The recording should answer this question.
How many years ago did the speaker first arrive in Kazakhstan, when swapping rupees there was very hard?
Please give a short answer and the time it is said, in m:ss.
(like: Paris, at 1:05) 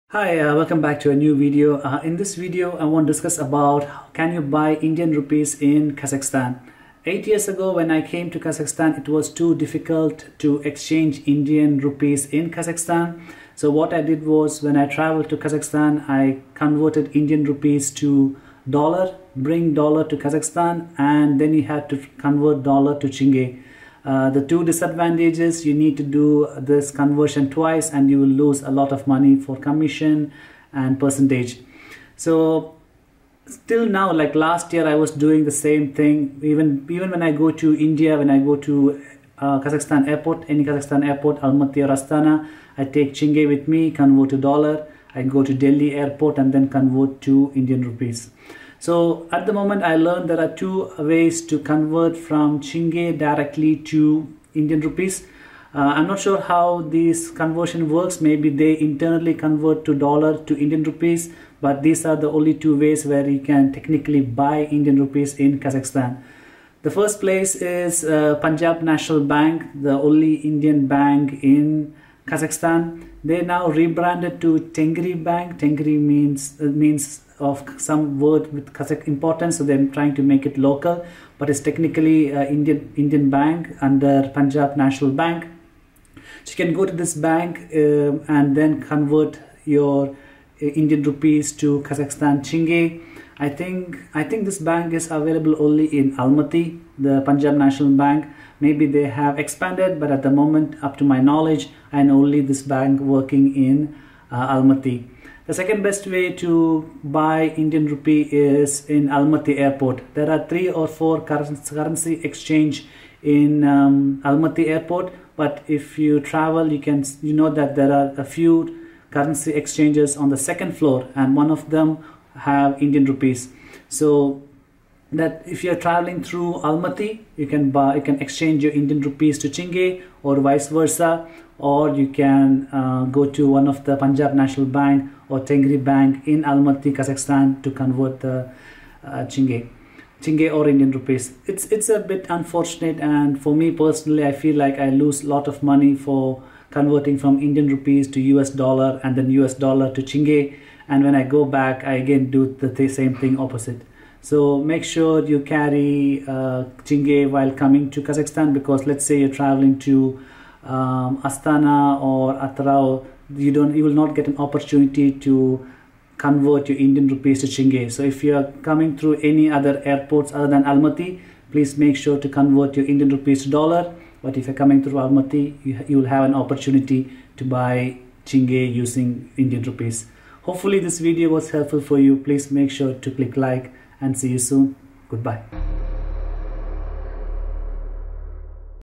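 8, at 0:07.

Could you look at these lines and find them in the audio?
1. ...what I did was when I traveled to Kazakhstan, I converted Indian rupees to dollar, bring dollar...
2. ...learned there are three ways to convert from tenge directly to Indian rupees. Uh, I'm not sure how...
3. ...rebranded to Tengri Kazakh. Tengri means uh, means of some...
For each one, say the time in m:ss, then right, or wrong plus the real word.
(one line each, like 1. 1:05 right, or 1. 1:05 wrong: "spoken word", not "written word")
1. 0:13 right
2. 0:49 wrong: "two", not "three"
3. 1:13 wrong: "Bank", not "Kazakh".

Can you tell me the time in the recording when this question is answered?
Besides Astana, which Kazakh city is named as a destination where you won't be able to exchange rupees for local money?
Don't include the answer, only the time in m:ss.
2:42.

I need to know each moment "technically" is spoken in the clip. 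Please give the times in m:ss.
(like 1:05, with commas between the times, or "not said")
1:03, 1:21.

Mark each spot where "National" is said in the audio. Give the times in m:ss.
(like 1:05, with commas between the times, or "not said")
1:08, 1:24, 1:37, 2:14.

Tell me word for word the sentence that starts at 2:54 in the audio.
But if you're coming through Almaty, you, you will have an opportunity to buy tenge using Indian rupees.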